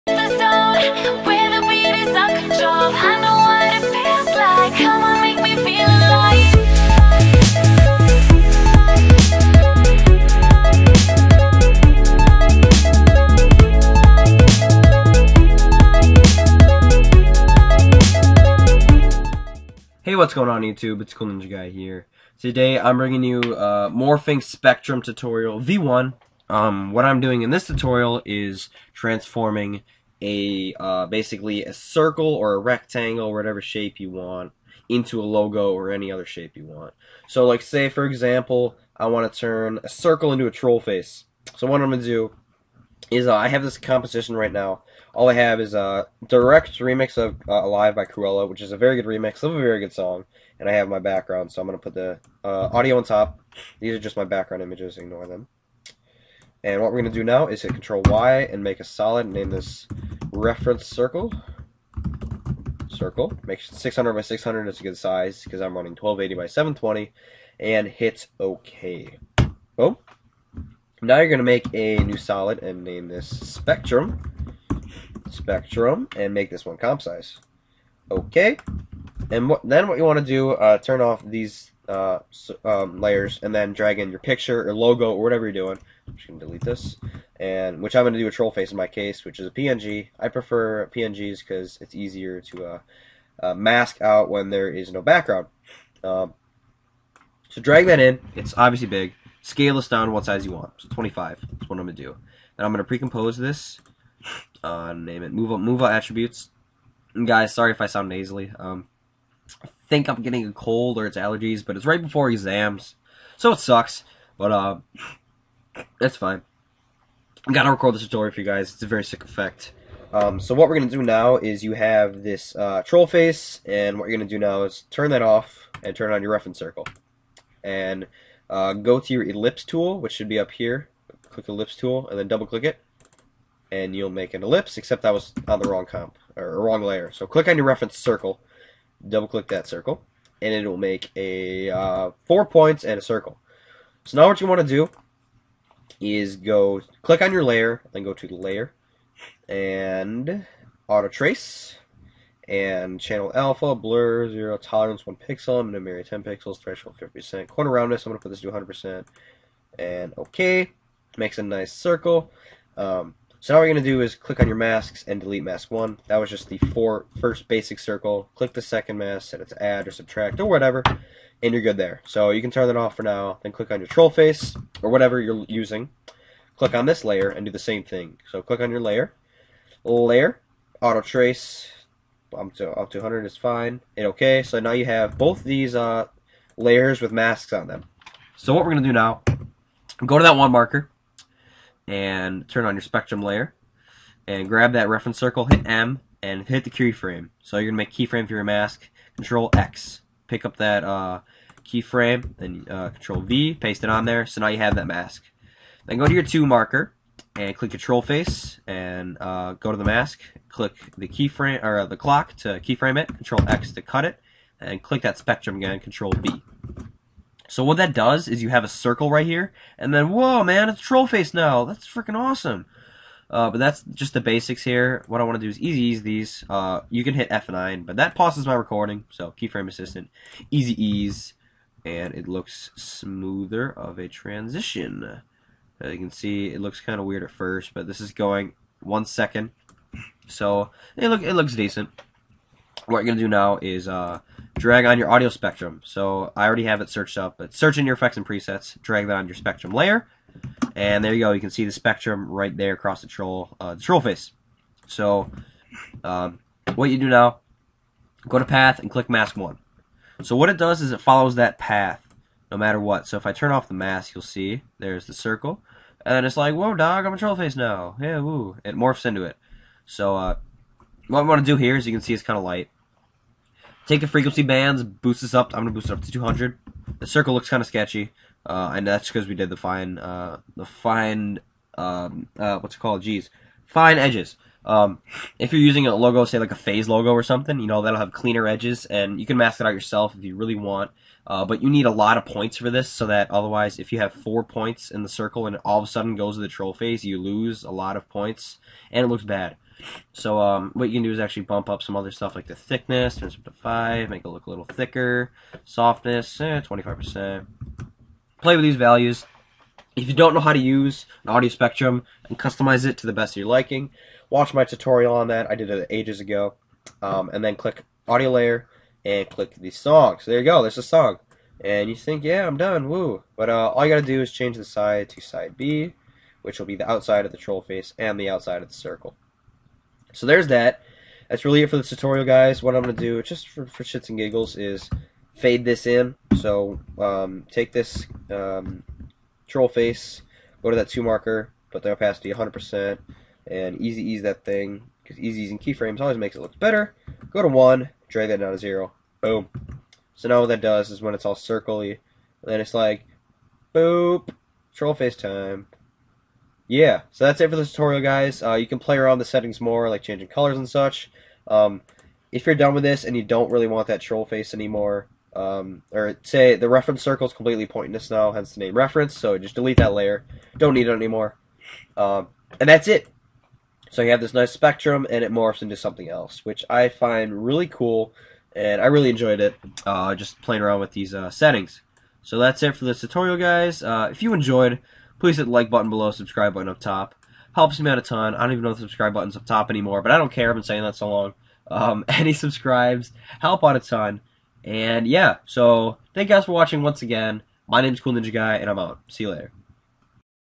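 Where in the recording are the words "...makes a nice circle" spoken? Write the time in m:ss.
2:41.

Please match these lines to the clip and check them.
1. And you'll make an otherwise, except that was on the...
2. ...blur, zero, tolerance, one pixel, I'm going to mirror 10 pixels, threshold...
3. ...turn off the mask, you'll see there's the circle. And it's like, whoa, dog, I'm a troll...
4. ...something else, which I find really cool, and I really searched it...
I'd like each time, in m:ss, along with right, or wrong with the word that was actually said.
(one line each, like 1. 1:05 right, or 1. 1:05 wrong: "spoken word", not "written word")
1. 2:13 wrong: "ellipse", not "otherwise"
2. 2:33 right
3. 4:23 right
4. 6:15 wrong: "enjoyed", not "searched".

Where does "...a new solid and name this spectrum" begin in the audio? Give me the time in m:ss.
1:11.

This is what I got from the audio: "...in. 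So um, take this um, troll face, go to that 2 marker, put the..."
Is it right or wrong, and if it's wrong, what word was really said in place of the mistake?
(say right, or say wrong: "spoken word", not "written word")
right.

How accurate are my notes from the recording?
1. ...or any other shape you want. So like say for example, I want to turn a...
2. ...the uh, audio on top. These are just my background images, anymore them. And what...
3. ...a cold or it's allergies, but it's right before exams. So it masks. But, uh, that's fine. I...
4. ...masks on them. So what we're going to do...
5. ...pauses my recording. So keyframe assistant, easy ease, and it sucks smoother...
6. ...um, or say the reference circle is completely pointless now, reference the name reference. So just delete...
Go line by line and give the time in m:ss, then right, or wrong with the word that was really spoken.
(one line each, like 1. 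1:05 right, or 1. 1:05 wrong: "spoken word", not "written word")
1. 0:35 right
2. 0:51 wrong: "ignore", not "anymore"
3. 1:50 wrong: "sucks", not "masks"
4. 3:07 right
5. 3:48 wrong: "looks", not "sucks"
6. 6:05 wrong: "hence", not "reference".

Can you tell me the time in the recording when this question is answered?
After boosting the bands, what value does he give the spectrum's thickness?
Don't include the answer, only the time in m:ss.
5:03.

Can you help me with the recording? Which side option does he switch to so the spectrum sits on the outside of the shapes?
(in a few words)
side B.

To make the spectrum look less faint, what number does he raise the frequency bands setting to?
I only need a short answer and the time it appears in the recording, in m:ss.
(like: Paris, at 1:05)
200, at 4:36.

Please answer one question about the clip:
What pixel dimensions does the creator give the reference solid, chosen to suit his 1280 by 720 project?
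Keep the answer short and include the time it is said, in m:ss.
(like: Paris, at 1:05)
600 by 600, at 1:03.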